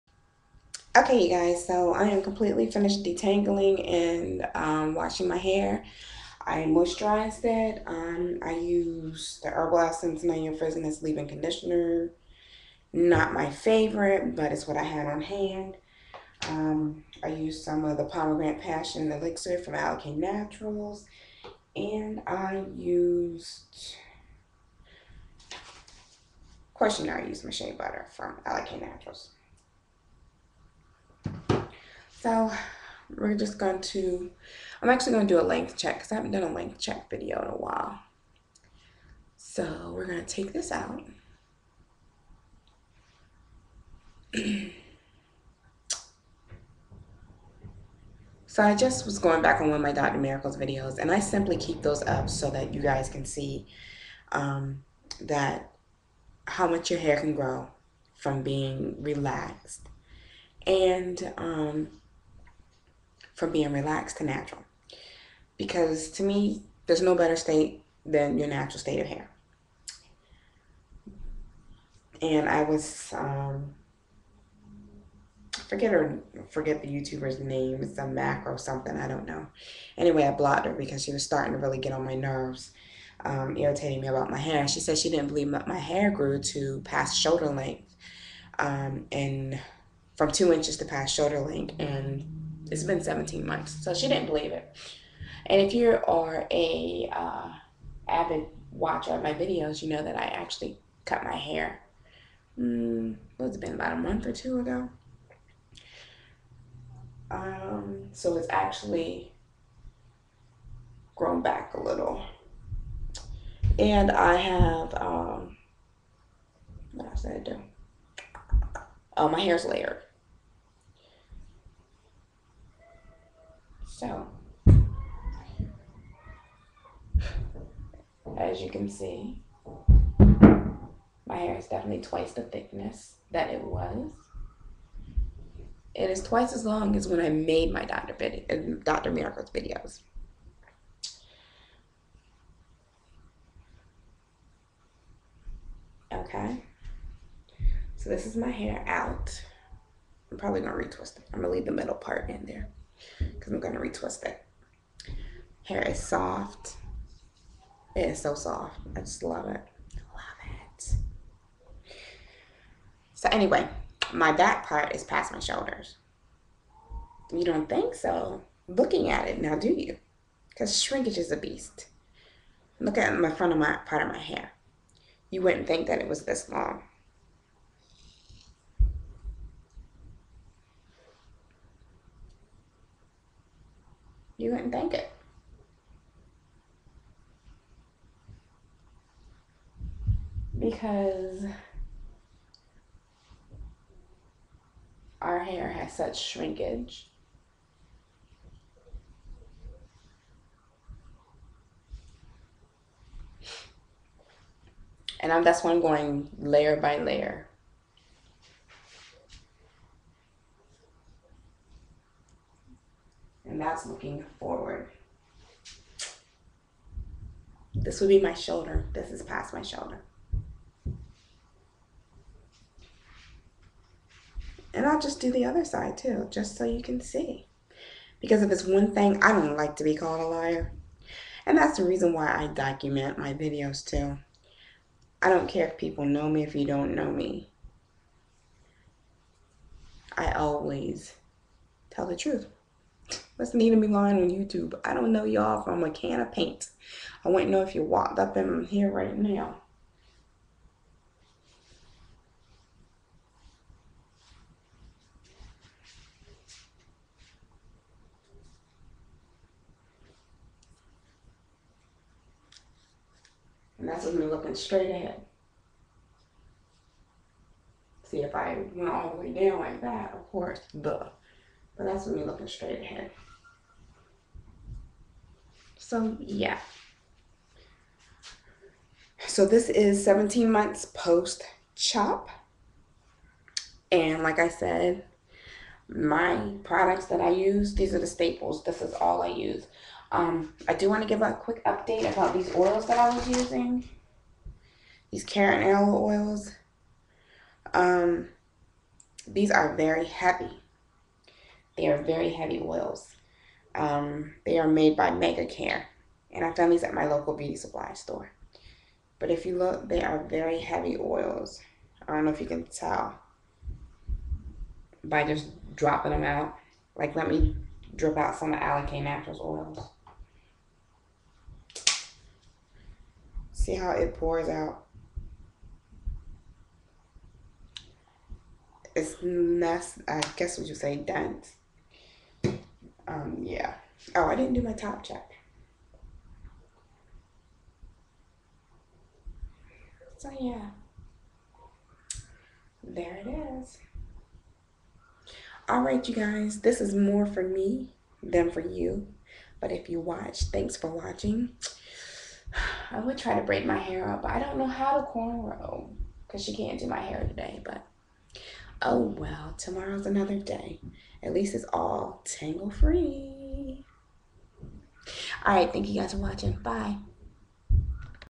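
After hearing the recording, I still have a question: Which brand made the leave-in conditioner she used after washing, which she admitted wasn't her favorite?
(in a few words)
Herbal Essence.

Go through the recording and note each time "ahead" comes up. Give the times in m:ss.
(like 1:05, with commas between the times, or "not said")
4:24, 4:32.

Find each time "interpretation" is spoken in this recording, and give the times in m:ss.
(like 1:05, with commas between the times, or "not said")
not said.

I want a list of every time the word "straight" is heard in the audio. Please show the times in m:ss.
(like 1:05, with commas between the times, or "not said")
4:24, 4:32.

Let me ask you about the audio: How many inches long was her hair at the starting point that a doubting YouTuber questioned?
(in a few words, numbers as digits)
2.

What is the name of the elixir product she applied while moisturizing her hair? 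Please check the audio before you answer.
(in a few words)
Pomegranate Passion Elixir.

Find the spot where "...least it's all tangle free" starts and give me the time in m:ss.
6:01.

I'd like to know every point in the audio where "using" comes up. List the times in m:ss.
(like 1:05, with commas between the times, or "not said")
4:53.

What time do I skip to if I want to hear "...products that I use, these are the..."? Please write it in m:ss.
4:46.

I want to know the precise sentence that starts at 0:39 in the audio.
So we're going to take this out.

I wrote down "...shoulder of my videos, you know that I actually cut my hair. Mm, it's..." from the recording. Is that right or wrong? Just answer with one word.
wrong.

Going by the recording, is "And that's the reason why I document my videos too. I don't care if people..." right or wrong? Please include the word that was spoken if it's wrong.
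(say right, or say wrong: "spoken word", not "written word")
right.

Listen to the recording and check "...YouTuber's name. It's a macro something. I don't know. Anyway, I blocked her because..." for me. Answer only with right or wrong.
right.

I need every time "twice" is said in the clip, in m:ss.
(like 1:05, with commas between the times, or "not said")
2:12, 2:16.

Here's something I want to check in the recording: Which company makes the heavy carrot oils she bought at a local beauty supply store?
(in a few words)
MegaCare.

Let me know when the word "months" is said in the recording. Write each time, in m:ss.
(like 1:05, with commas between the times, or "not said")
1:33, 1:43, 4:40.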